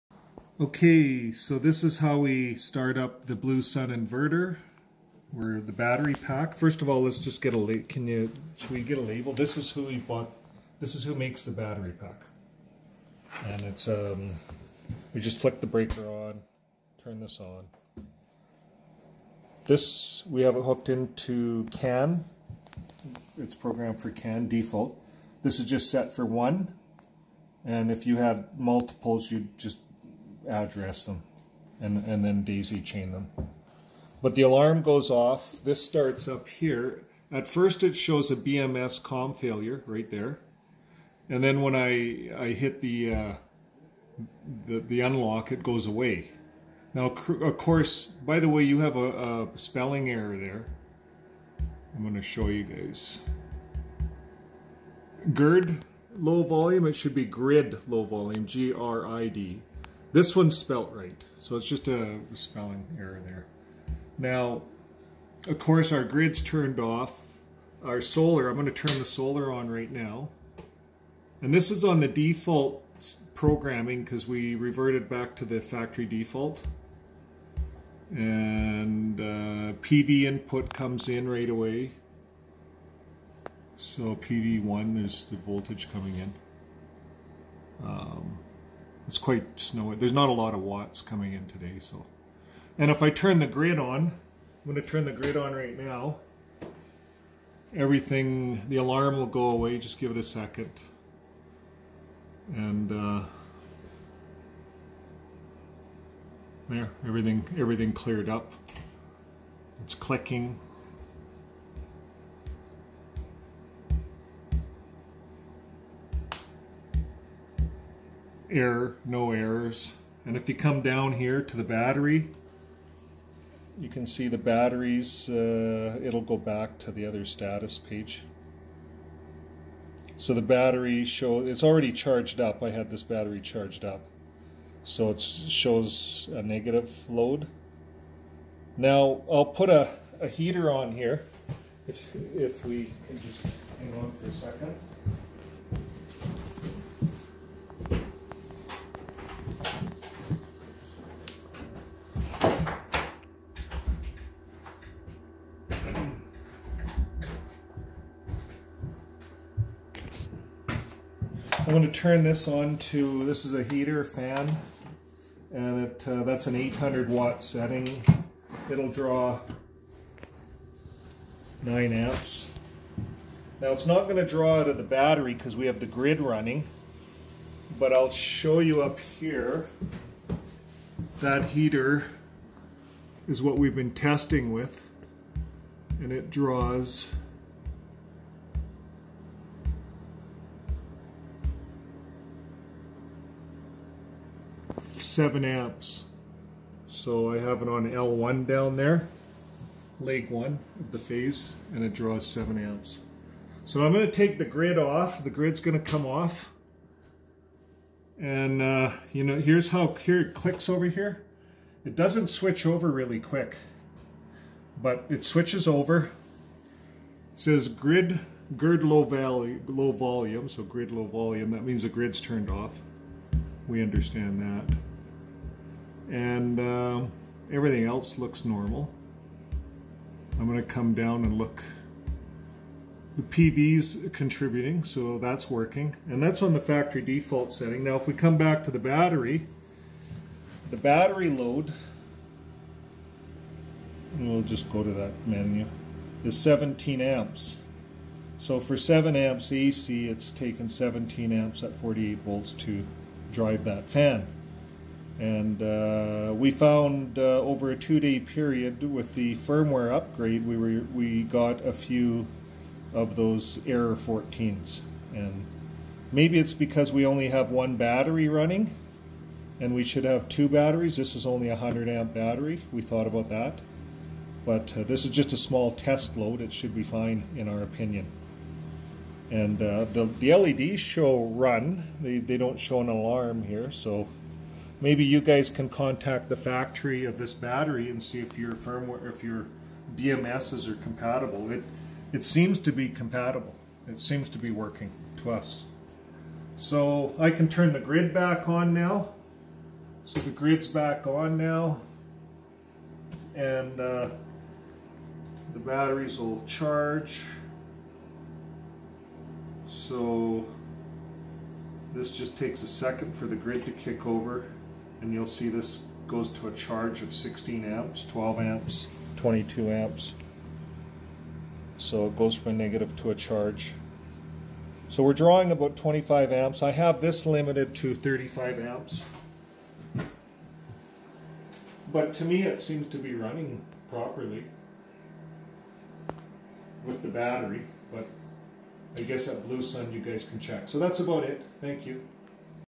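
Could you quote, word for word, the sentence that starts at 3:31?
It doesn't switch over really quick, but it switches over.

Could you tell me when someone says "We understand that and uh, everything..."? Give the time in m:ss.
3:43.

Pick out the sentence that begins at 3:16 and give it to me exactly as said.
So I have it on L1 down there, leg 1 of the phase, and it draws 7 amps.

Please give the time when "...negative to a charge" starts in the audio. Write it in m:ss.
5:22.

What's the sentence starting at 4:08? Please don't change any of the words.
So for 7 amps AC, it's taken 17 amps at 48 volts to drive that fan.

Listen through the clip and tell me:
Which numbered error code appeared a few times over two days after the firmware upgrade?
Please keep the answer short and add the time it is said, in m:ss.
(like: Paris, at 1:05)
14, at 4:23.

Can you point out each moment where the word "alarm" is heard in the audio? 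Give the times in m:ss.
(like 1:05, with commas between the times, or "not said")
0:34, 1:38, 4:42.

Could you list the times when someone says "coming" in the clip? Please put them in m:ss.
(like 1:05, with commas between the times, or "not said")
1:25, 1:31.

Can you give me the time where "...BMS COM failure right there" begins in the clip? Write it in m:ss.
0:38.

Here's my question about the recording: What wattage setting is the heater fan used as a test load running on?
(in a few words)
800 watts.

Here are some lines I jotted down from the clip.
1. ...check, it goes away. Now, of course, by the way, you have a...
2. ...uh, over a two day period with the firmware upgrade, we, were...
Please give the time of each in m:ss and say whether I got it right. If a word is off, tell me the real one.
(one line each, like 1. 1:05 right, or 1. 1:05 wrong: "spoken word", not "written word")
1. 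0:45 wrong: "unlock", not "check"
2. 4:17 right.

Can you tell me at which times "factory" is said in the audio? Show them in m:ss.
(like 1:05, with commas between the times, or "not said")
1:15, 3:56, 4:46.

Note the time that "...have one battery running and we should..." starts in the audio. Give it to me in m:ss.
4:27.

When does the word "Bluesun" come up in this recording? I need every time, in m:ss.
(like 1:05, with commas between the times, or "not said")
0:03, 5:39.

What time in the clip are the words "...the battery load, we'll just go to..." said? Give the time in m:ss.
4:00.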